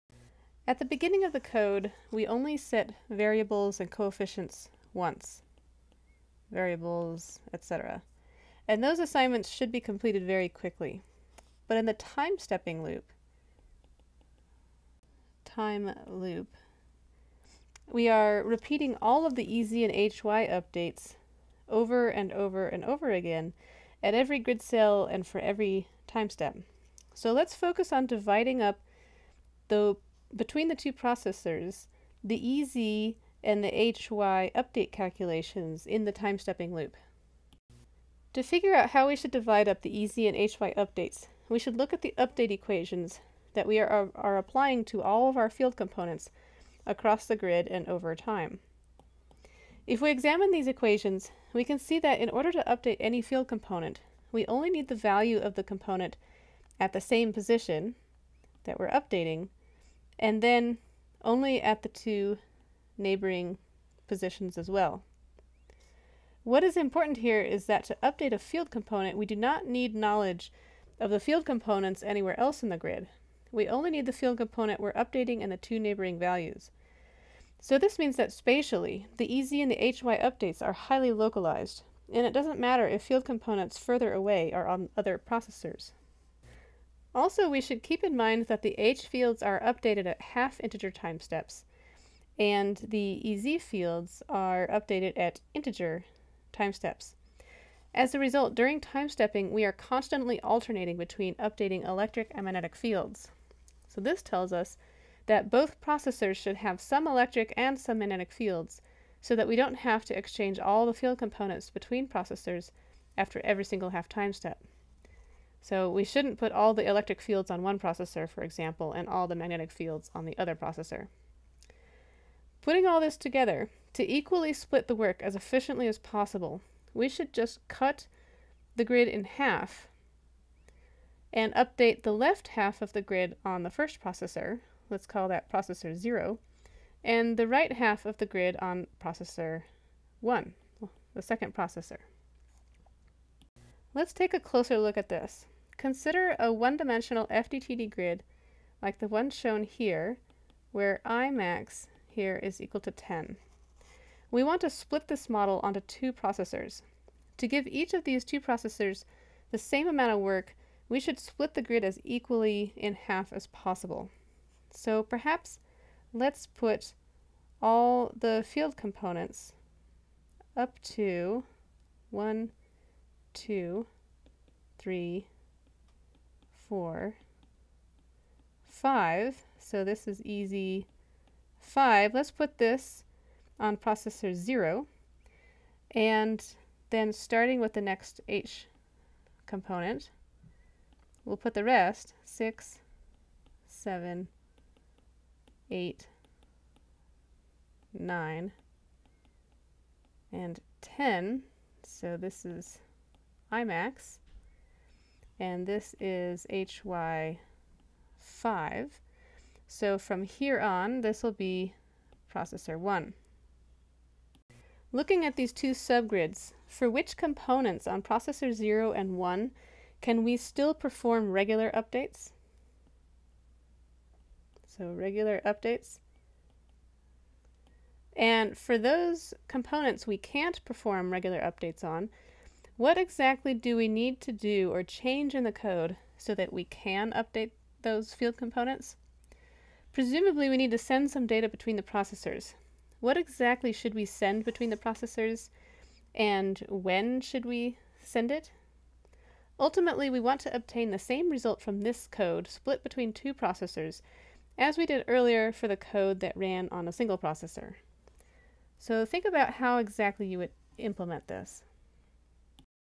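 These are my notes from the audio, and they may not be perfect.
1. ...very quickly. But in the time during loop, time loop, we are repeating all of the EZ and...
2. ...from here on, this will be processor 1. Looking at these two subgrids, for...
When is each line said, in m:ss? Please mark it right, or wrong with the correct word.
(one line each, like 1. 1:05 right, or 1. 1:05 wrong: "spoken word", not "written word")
1. 0:10 wrong: "stepping", not "during"
2. 3:29 right.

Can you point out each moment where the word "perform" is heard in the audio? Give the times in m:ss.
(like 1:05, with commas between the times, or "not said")
3:40, 3:50.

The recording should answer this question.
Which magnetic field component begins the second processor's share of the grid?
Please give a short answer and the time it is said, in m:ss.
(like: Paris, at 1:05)
HY5, at 3:26.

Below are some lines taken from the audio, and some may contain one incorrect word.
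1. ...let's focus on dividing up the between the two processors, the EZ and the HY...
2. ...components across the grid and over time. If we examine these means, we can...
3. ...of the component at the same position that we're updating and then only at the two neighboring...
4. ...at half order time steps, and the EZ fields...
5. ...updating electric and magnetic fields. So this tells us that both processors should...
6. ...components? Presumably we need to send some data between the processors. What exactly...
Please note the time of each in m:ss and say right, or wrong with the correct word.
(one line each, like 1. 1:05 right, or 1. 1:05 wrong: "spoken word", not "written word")
1. 0:27 right
2. 0:45 wrong: "equations", not "means"
3. 0:55 right
4. 1:30 wrong: "integer", not "order"
5. 1:41 right
6. 3:58 right.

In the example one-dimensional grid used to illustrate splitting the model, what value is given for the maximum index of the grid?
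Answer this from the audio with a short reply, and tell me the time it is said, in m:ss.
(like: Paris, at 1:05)
10, at 2:32.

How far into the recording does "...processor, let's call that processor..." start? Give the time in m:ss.
2:14.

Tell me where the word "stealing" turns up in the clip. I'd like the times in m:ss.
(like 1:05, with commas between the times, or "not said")
not said.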